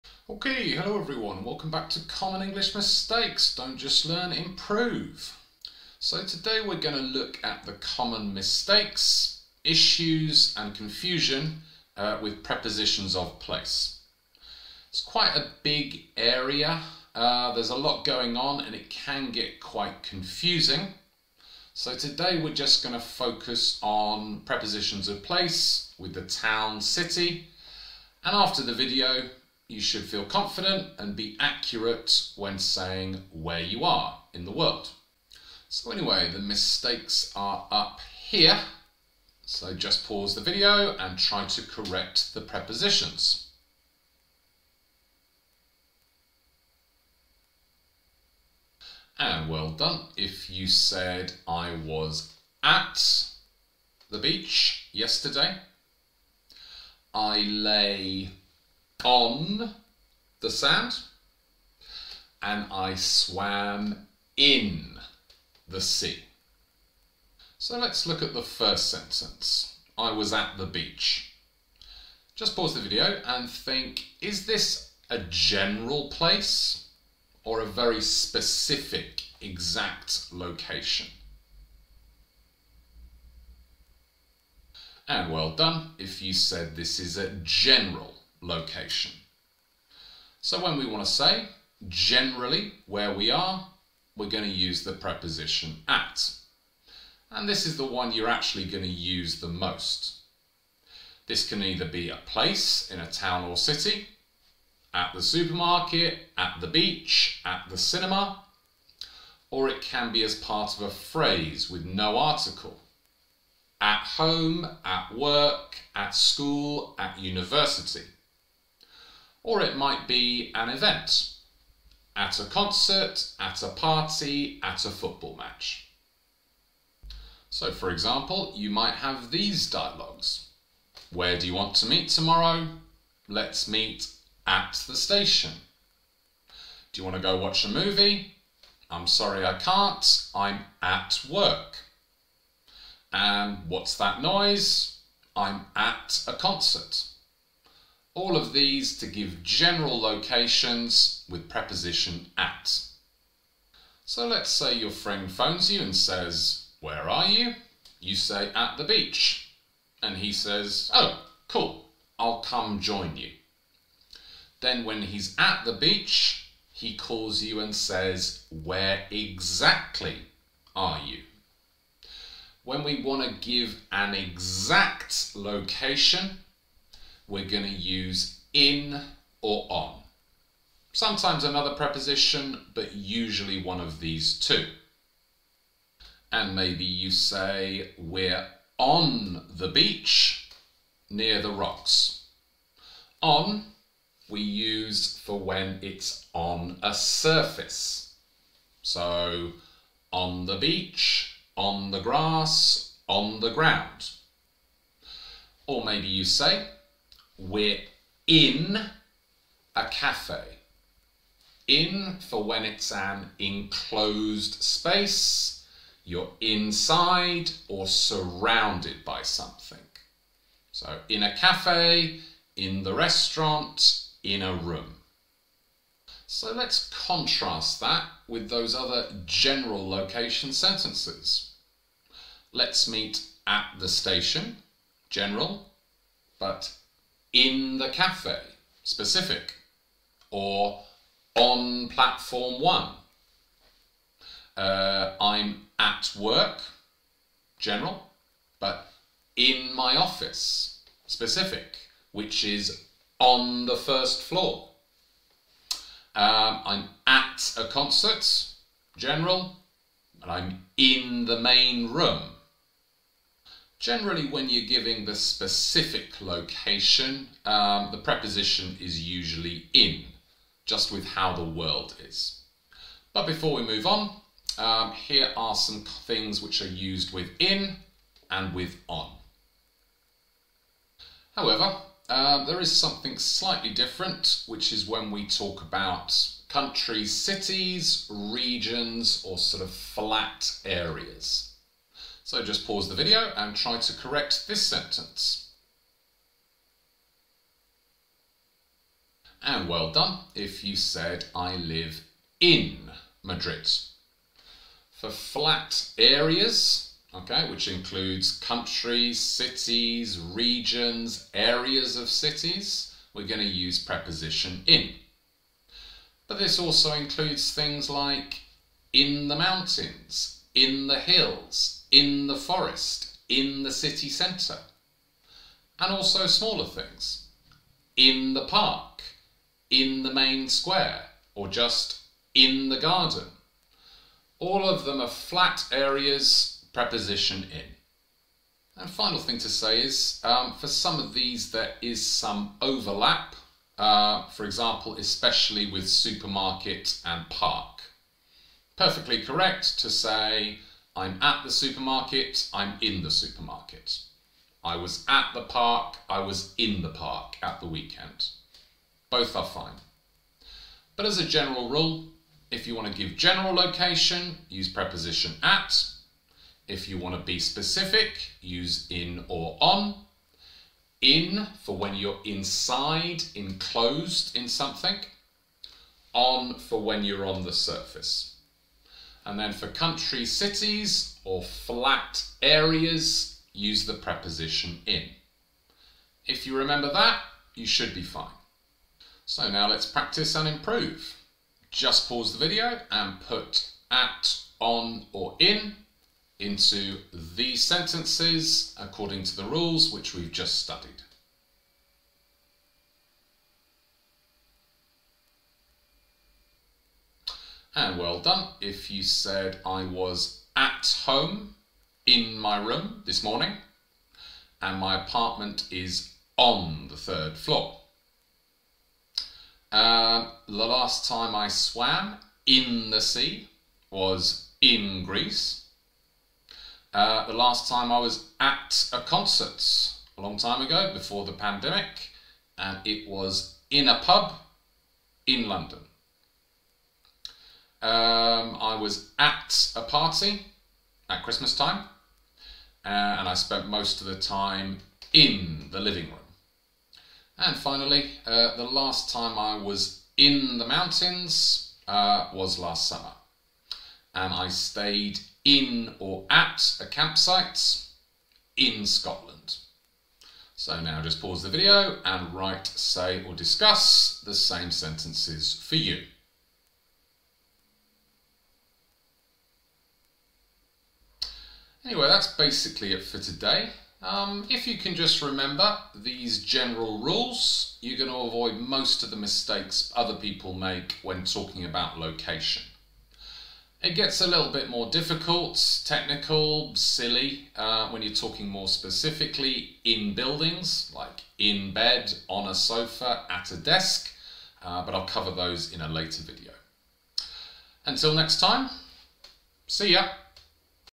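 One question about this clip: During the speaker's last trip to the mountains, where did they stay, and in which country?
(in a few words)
a campsite in Scotland.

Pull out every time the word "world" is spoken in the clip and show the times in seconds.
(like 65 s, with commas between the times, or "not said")
34 s, 271 s.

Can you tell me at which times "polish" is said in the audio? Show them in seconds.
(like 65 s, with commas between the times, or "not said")
not said.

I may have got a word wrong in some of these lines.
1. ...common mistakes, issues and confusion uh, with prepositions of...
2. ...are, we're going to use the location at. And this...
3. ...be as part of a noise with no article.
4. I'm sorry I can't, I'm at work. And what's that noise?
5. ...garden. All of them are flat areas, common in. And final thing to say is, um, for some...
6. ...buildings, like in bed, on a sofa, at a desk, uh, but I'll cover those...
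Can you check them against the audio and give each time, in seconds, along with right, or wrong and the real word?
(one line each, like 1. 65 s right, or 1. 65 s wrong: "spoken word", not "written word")
1. 7 s right
2. 93 s wrong: "preposition", not "location"
3. 110 s wrong: "phrase", not "noise"
4. 138 s right
5. 332 s wrong: "preposition", not "common"
6. 490 s right.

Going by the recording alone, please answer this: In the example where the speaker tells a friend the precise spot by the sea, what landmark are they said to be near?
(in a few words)
the rocks.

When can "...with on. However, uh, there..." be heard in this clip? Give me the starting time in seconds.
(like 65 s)
278 s.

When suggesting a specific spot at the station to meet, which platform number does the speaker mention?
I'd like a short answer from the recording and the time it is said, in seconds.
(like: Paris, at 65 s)
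1, at 241 s.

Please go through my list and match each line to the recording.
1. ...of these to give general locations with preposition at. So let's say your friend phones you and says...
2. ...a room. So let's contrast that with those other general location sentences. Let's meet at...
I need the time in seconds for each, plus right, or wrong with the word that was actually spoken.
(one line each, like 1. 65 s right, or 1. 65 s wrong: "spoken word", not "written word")
1. 148 s right
2. 224 s right.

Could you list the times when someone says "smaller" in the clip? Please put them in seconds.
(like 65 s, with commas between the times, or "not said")
326 s.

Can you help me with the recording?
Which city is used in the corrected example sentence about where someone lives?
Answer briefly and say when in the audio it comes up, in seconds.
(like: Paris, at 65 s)
Madrid, at 303 s.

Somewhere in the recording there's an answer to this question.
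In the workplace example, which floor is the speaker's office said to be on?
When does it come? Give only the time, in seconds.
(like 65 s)
253 s.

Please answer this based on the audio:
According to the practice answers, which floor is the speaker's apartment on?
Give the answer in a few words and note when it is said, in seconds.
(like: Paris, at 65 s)
the third floor, at 416 s.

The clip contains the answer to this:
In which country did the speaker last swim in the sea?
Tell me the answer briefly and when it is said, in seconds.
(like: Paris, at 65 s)
Greece, at 425 s.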